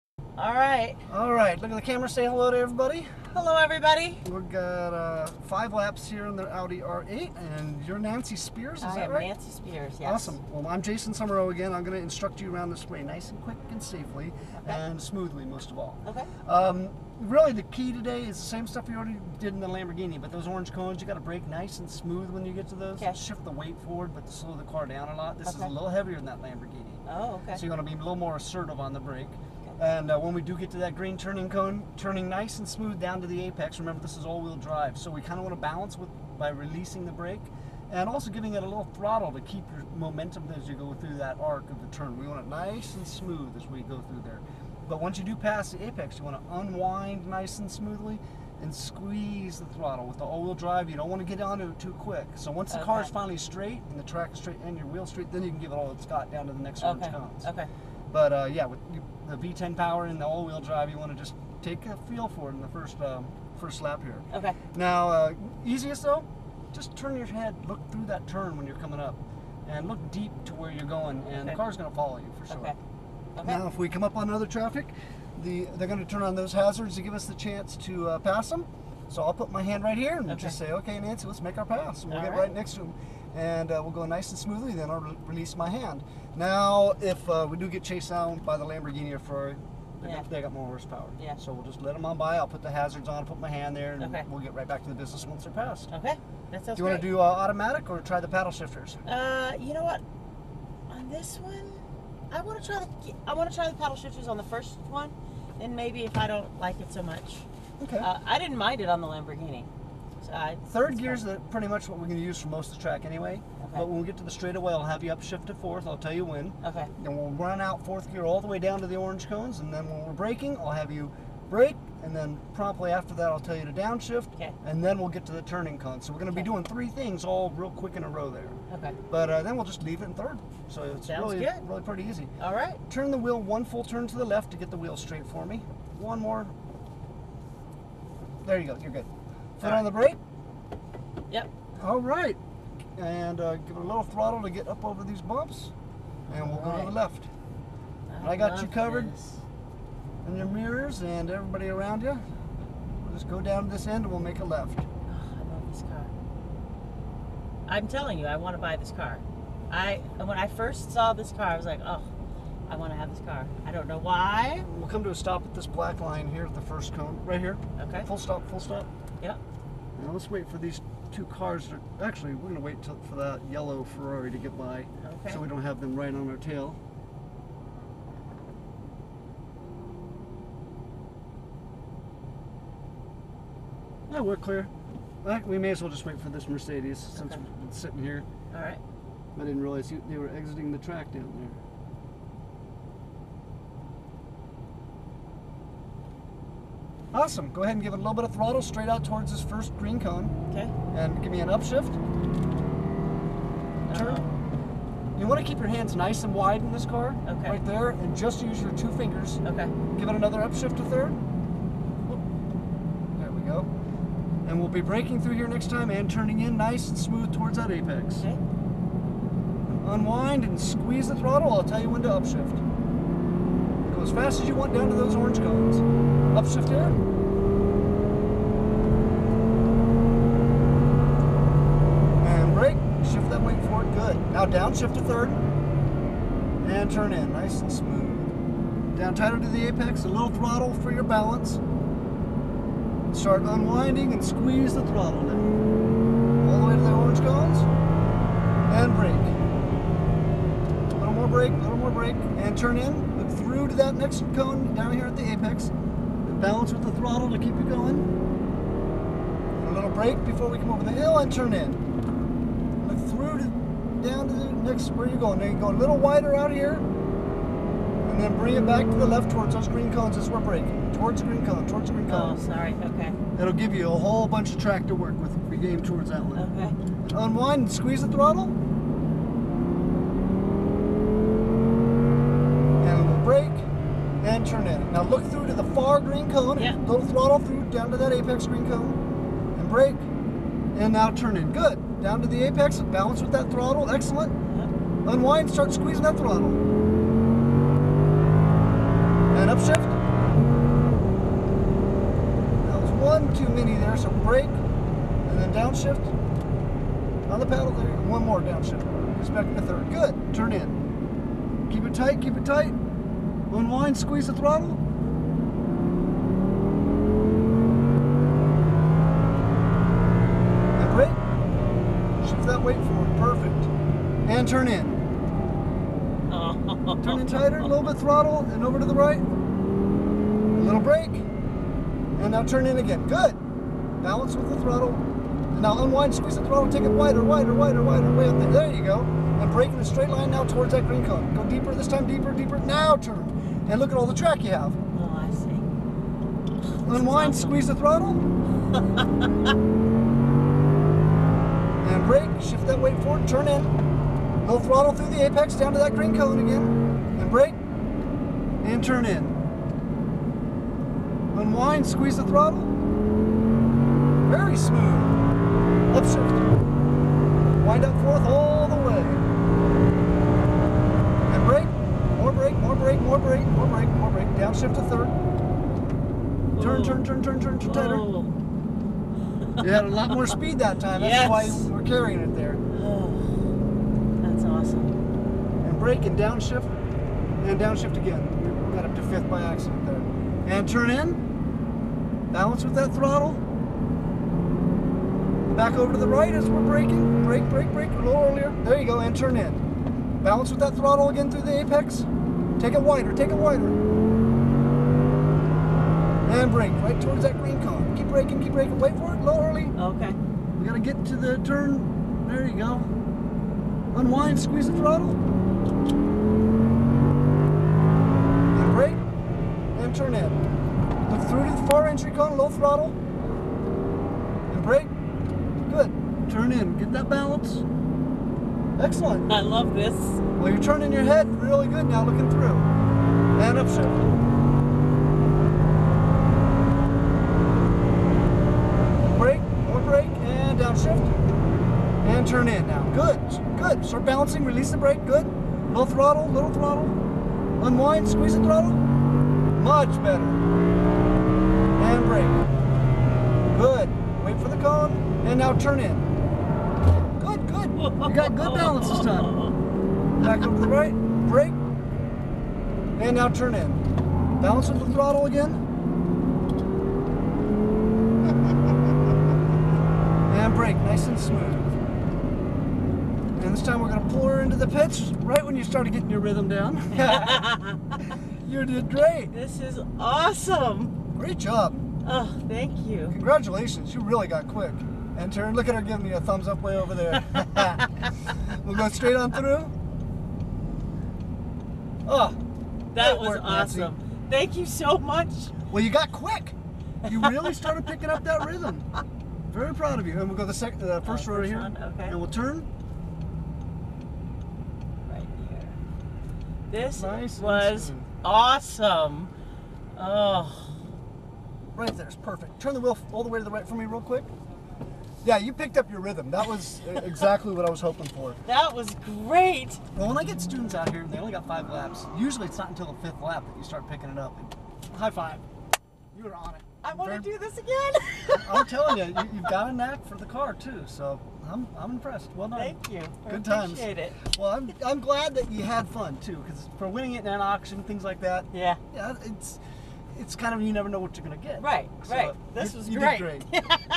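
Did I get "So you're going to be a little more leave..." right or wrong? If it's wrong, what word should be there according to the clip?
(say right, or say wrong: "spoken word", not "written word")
wrong: "assertive", not "leave".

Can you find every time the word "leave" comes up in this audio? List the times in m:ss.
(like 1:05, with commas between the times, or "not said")
2:09.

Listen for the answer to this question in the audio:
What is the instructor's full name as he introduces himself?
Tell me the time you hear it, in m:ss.
0:10.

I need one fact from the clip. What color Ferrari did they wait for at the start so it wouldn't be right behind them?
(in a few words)
Yellow.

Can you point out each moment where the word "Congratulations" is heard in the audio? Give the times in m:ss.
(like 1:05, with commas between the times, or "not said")
8:03.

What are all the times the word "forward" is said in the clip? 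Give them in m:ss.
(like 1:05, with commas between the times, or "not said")
0:23, 3:53, 5:53.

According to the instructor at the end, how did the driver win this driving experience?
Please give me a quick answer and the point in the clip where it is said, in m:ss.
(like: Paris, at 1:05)
An auction, at 8:57.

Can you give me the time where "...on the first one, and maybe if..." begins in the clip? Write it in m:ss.
1:44.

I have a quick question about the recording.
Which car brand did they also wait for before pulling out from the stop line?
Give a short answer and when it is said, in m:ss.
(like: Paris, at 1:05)
Mercedes, at 3:06.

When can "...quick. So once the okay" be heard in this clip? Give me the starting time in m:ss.
0:51.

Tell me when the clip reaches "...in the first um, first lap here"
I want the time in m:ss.
1:02.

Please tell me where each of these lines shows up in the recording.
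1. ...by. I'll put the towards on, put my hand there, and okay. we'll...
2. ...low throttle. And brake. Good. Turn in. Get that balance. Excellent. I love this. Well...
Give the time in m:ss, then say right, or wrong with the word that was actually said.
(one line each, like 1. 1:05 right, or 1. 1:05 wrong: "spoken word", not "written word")
1. 1:32 wrong: "hazards", not "towards"
2. 7:02 right.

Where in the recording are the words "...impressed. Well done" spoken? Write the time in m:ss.
8:51.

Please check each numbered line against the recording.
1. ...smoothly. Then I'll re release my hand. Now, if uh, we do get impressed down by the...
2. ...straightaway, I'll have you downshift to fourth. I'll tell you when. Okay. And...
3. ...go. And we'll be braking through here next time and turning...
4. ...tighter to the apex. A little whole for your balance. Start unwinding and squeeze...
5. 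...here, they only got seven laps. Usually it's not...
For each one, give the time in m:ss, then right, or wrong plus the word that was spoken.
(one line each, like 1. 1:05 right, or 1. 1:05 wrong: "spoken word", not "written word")
1. 1:24 wrong: "chased", not "impressed"
2. 1:54 wrong: "upshift", not "downshift"
3. 3:33 right
4. 3:59 wrong: "throttle", not "whole"
5. 8:40 wrong: "five", not "seven".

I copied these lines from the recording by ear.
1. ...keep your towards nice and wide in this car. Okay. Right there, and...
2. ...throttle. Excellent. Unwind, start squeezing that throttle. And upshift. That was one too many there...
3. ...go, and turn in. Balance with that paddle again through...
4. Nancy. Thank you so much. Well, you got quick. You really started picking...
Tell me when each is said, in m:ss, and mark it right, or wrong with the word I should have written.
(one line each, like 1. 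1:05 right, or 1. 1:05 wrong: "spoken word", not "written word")
1. 3:25 wrong: "hands", not "towards"
2. 4:53 right
3. 6:38 wrong: "throttle", not "paddle"
4. 8:13 right.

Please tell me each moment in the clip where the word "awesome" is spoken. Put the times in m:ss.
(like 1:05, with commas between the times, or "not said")
0:10, 3:17, 5:47, 7:59, 8:13, 8:28.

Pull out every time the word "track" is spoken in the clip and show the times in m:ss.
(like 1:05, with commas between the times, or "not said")
0:54, 1:52, 3:10, 4:34, 5:44.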